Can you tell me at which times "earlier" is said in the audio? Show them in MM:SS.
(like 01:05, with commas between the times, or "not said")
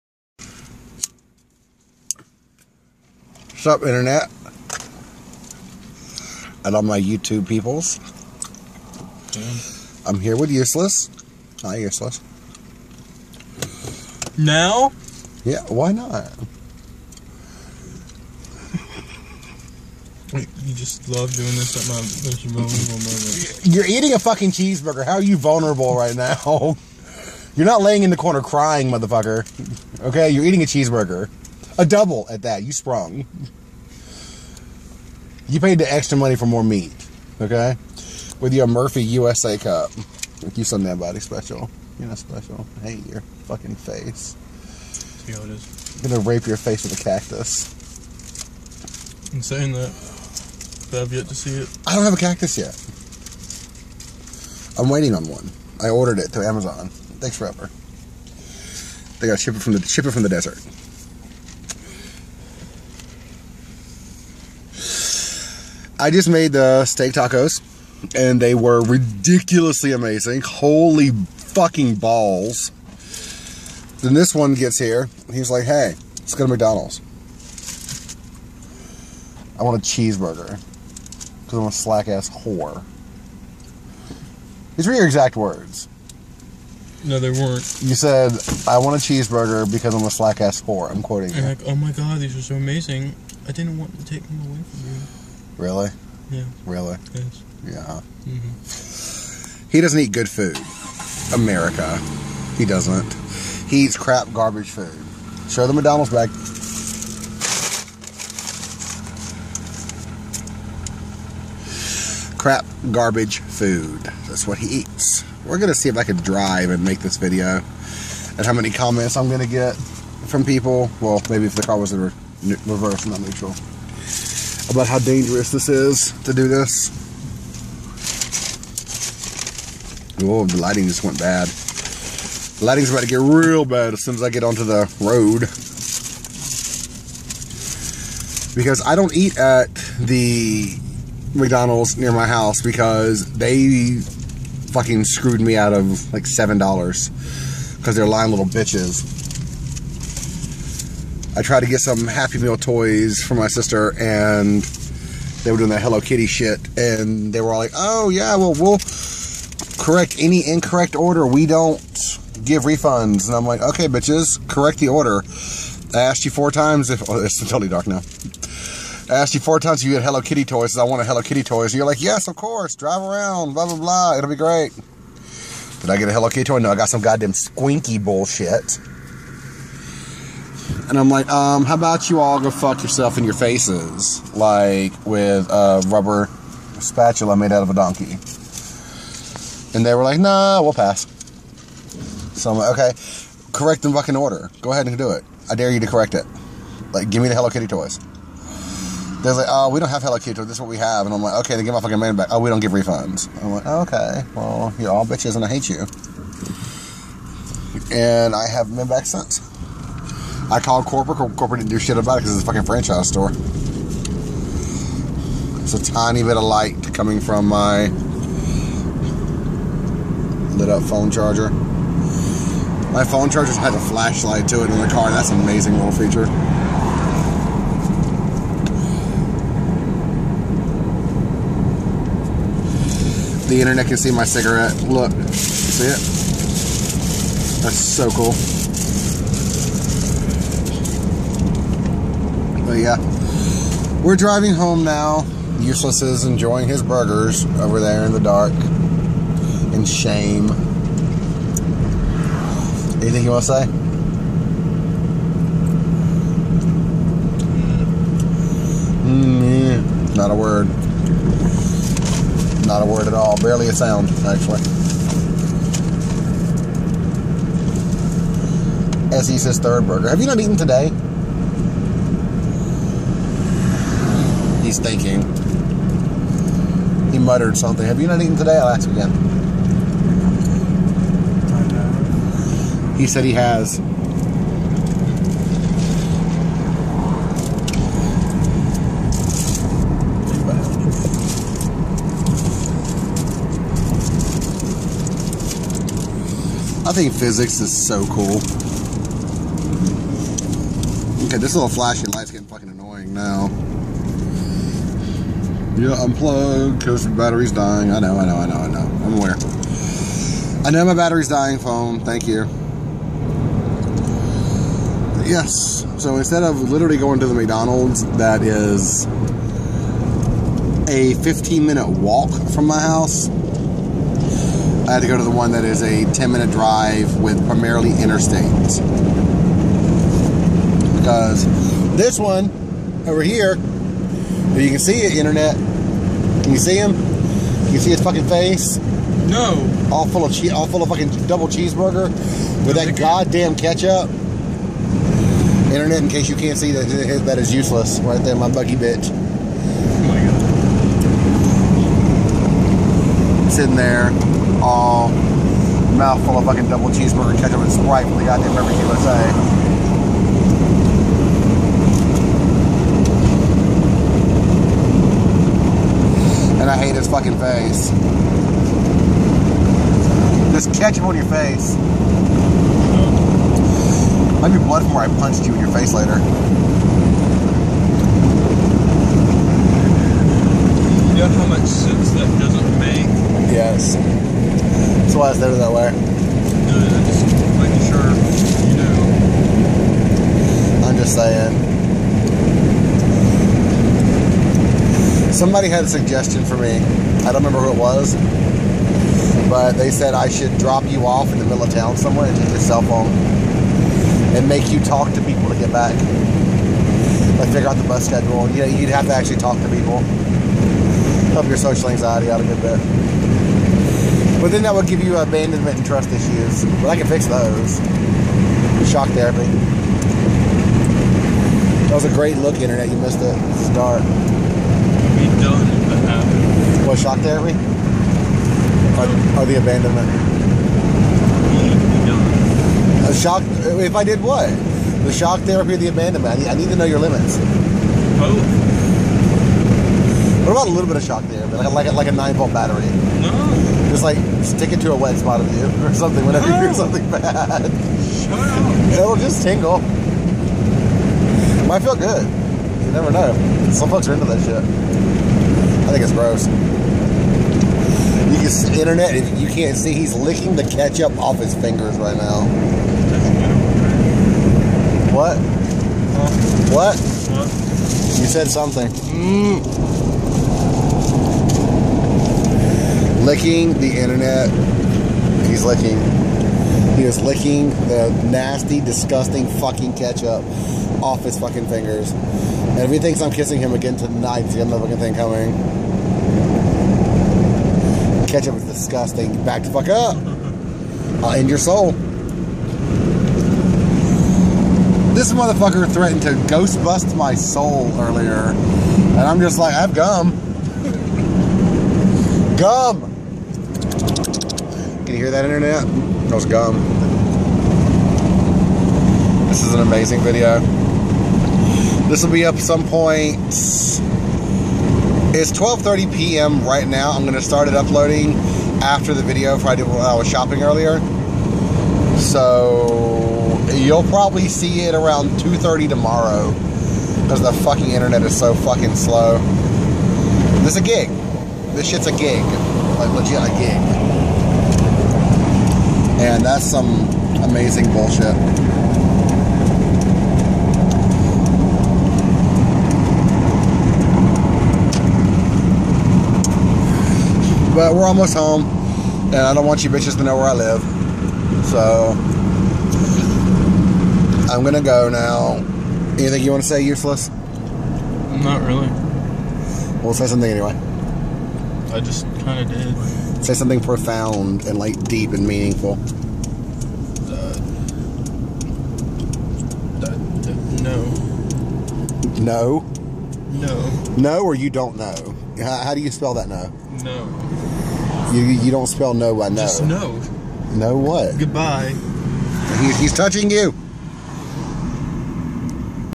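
08:17, 08:40.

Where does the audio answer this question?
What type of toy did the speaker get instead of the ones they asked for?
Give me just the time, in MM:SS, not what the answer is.
02:57.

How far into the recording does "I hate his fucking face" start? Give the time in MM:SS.
06:06.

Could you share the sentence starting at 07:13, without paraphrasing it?
A shock, if I did what?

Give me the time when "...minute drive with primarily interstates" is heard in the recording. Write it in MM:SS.
05:26.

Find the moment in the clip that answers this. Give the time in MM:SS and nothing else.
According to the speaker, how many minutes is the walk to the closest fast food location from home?
05:21.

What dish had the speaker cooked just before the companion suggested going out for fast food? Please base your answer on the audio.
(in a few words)
steak tacos.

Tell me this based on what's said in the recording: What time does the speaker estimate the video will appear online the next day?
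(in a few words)
2:30.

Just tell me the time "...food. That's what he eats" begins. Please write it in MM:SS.
01:53.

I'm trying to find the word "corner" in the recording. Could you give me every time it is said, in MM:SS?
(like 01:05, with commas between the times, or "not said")
00:28.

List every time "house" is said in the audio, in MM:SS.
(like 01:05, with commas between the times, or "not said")
02:22, 05:22.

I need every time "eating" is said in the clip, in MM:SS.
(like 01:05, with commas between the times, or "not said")
00:23, 00:30.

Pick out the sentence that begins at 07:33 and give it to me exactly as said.
Some folks are into that shit.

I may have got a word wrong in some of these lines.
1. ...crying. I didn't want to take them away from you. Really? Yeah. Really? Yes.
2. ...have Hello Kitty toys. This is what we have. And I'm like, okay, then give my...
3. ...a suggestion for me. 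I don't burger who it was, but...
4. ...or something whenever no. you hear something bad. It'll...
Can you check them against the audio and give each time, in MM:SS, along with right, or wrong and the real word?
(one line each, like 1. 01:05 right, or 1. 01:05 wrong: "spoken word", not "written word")
1. 01:32 wrong: "amazing", not "crying"
2. 03:19 right
3. 06:35 wrong: "remember", not "burger"
4. 07:25 right.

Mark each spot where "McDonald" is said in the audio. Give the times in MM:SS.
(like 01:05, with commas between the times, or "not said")
01:16, 01:45, 02:21, 05:17.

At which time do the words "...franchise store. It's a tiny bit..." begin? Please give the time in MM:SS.
03:32.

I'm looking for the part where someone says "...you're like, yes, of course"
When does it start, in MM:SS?
02:51.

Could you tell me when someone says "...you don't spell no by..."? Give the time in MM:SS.
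09:38.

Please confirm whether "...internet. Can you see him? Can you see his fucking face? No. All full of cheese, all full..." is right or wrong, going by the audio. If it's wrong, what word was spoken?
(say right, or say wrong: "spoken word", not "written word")
right.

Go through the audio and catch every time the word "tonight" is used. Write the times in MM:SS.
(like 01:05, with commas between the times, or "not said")
08:03.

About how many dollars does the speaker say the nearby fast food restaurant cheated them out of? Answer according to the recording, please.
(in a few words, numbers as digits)
$7.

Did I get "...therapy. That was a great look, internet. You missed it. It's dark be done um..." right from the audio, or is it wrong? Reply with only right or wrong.
right.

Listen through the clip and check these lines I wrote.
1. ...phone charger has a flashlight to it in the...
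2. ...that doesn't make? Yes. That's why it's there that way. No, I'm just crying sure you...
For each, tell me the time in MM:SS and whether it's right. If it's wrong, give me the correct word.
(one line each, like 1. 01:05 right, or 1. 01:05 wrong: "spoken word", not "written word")
1. 03:43 right
2. 06:22 wrong: "making", not "crying".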